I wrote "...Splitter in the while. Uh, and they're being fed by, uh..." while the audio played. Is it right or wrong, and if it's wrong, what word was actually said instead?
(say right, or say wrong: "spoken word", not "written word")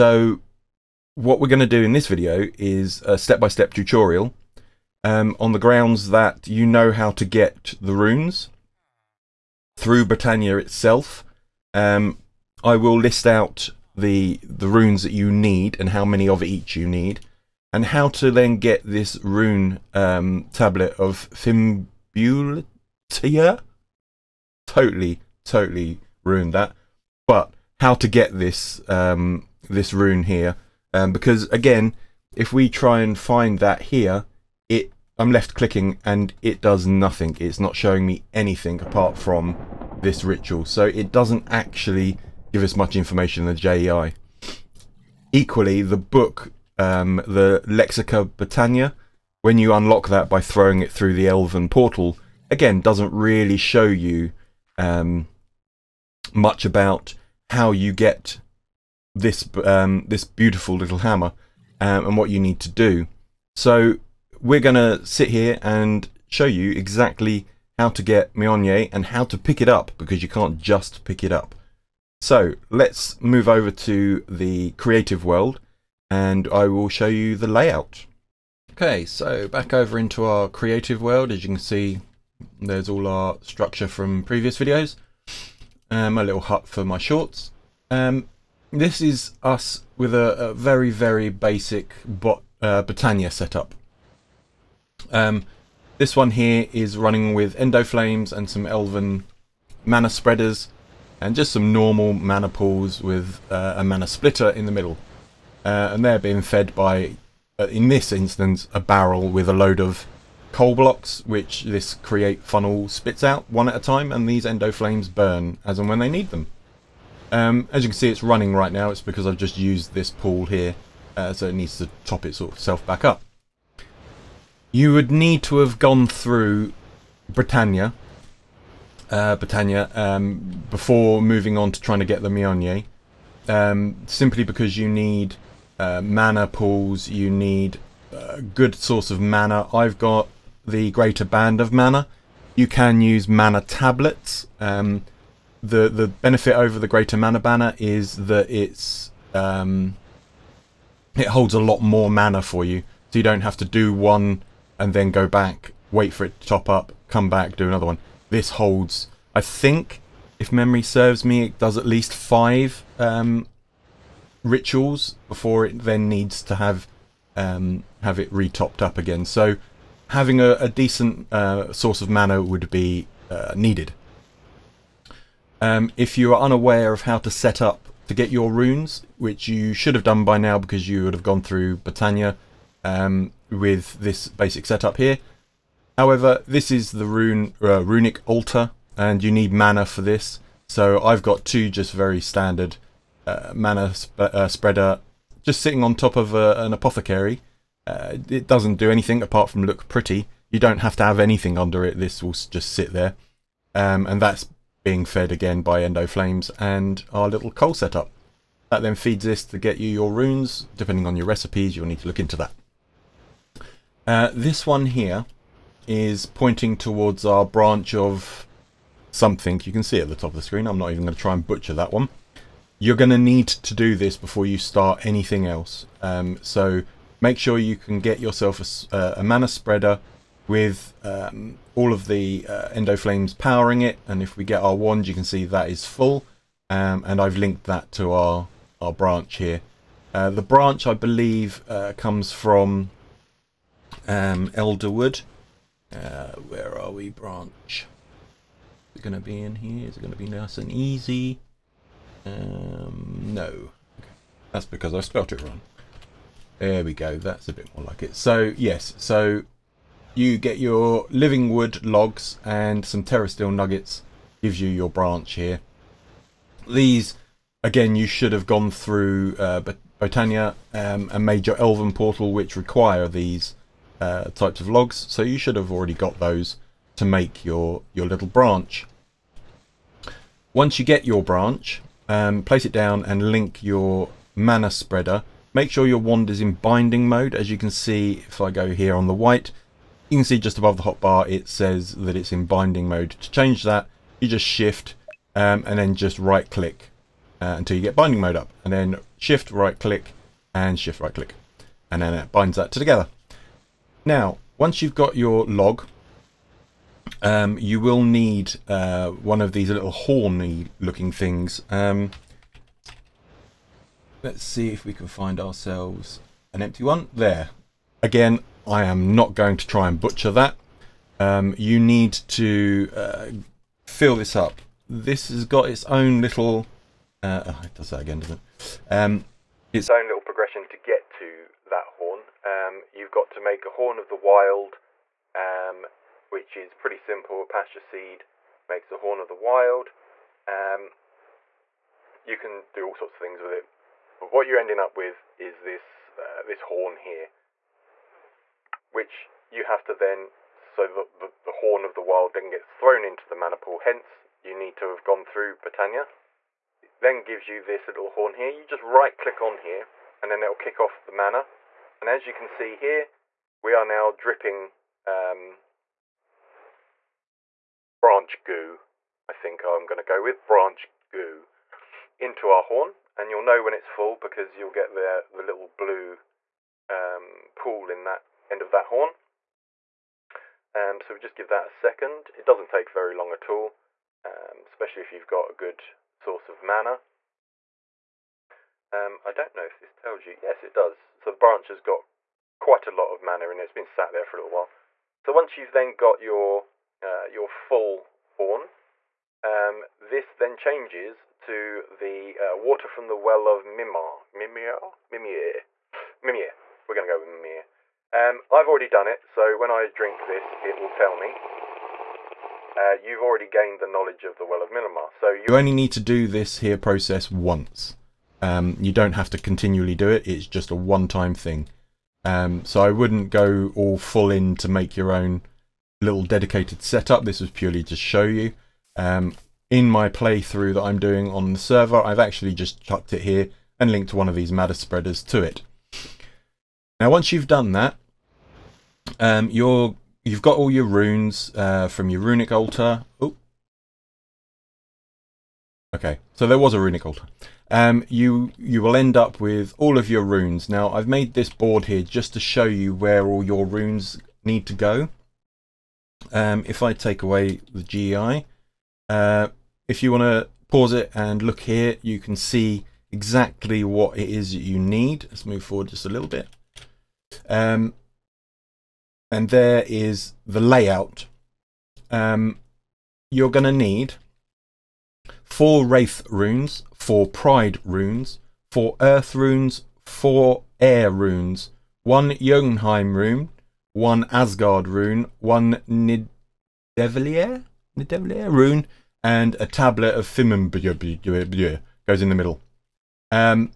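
wrong: "middle", not "while".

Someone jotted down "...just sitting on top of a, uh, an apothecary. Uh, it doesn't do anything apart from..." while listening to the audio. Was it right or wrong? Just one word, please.
right.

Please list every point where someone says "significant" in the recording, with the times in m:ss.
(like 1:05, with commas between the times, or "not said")
not said.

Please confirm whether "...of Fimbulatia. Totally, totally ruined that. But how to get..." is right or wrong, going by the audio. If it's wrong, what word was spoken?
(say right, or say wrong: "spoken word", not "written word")
right.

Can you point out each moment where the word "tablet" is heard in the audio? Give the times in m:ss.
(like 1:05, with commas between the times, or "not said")
0:20, 2:23, 8:09.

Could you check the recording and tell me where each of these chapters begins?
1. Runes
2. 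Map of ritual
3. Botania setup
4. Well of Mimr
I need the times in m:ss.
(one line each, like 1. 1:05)
1. 2:57
2. 7:30
3. 1:18
4. 3:30.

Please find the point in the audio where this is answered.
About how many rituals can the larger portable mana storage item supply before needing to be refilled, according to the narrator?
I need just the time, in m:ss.
2:42.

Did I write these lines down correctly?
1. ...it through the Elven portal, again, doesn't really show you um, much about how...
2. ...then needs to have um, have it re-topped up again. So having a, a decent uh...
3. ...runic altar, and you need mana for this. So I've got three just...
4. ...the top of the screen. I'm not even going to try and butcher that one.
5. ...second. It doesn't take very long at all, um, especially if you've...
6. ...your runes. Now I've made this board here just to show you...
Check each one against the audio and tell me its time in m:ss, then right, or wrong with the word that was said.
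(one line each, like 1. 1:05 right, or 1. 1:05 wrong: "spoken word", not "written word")
1. 0:50 right
2. 2:45 right
3. 3:07 wrong: "two", not "three"
4. 3:40 right
5. 6:21 right
6. 7:30 right.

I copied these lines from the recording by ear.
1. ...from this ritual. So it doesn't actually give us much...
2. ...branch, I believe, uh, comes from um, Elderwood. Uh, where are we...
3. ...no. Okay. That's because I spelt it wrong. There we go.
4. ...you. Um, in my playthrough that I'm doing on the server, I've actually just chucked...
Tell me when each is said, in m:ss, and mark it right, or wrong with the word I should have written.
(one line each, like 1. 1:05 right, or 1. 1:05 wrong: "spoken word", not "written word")
1. 0:39 right
2. 4:00 right
3. 4:13 right
4. 7:08 right.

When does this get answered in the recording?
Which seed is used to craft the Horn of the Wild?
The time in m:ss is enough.
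5:37.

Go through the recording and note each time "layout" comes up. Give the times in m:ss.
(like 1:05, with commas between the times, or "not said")
1:17, 7:50.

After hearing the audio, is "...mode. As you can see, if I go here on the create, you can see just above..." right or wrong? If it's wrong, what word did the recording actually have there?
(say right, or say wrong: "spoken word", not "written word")
wrong: "white", not "create".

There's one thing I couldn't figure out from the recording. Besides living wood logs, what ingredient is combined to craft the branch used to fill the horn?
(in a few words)
terra steel nuggets.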